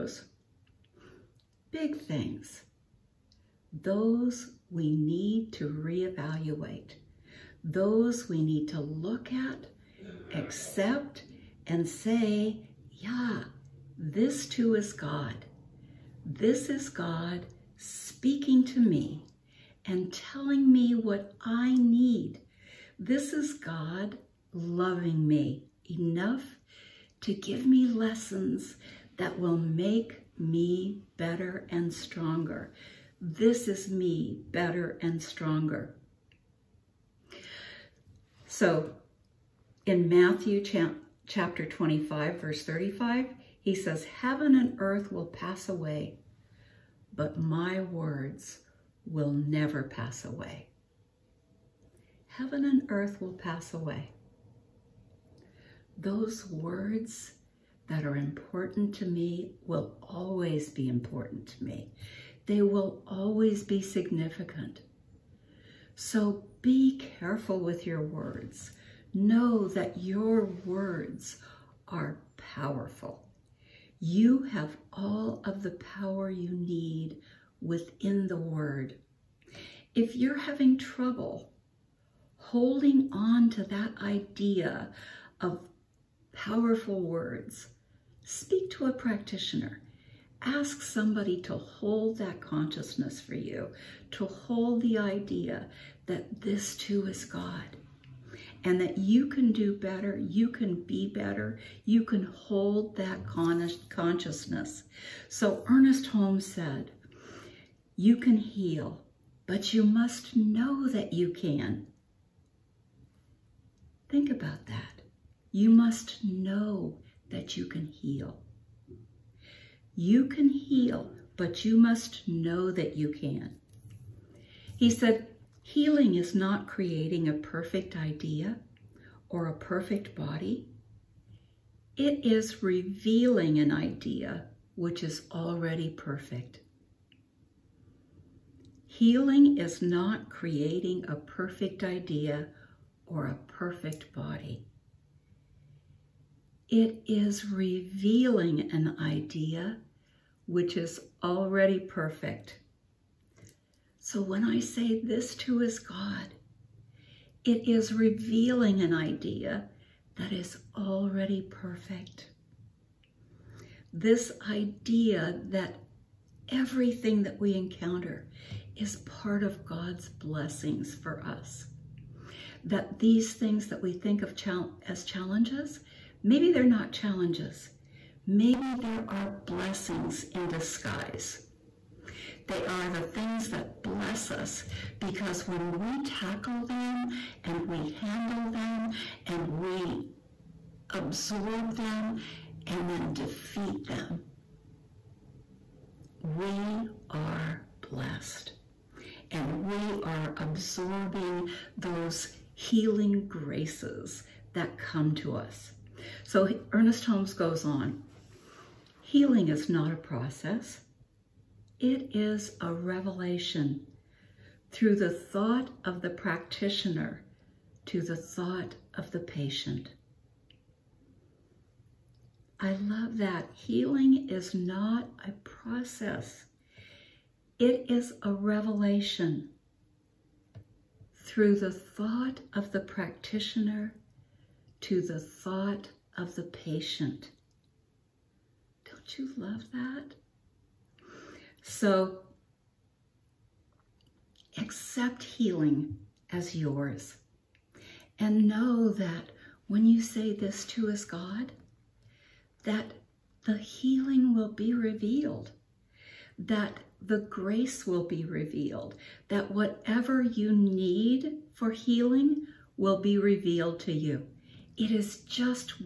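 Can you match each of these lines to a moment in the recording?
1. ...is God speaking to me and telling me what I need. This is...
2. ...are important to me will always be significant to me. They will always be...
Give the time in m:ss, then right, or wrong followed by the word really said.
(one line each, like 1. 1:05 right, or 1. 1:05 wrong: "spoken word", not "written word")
1. 0:16 right
2. 0:58 wrong: "important", not "significant".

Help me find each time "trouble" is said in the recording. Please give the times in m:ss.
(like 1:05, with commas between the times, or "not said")
1:20.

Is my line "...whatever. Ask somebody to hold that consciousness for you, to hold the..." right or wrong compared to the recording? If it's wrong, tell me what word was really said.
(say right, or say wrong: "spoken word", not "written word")
wrong: "practitioner", not "whatever".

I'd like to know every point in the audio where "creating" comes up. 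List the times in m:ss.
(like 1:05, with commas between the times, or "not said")
2:06, 2:20.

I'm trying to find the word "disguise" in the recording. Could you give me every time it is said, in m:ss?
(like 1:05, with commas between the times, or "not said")
3:00.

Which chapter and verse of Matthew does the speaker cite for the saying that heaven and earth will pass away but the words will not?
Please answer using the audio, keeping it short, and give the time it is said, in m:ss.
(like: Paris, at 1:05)
25:35, at 0:41.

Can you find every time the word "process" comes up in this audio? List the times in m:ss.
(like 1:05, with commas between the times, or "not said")
3:29, 3:45.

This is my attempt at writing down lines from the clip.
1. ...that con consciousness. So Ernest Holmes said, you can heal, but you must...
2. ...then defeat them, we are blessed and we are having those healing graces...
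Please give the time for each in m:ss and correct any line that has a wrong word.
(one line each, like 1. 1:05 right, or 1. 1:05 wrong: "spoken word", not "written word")
1. 1:42 right
2. 3:12 wrong: "absorbing", not "having".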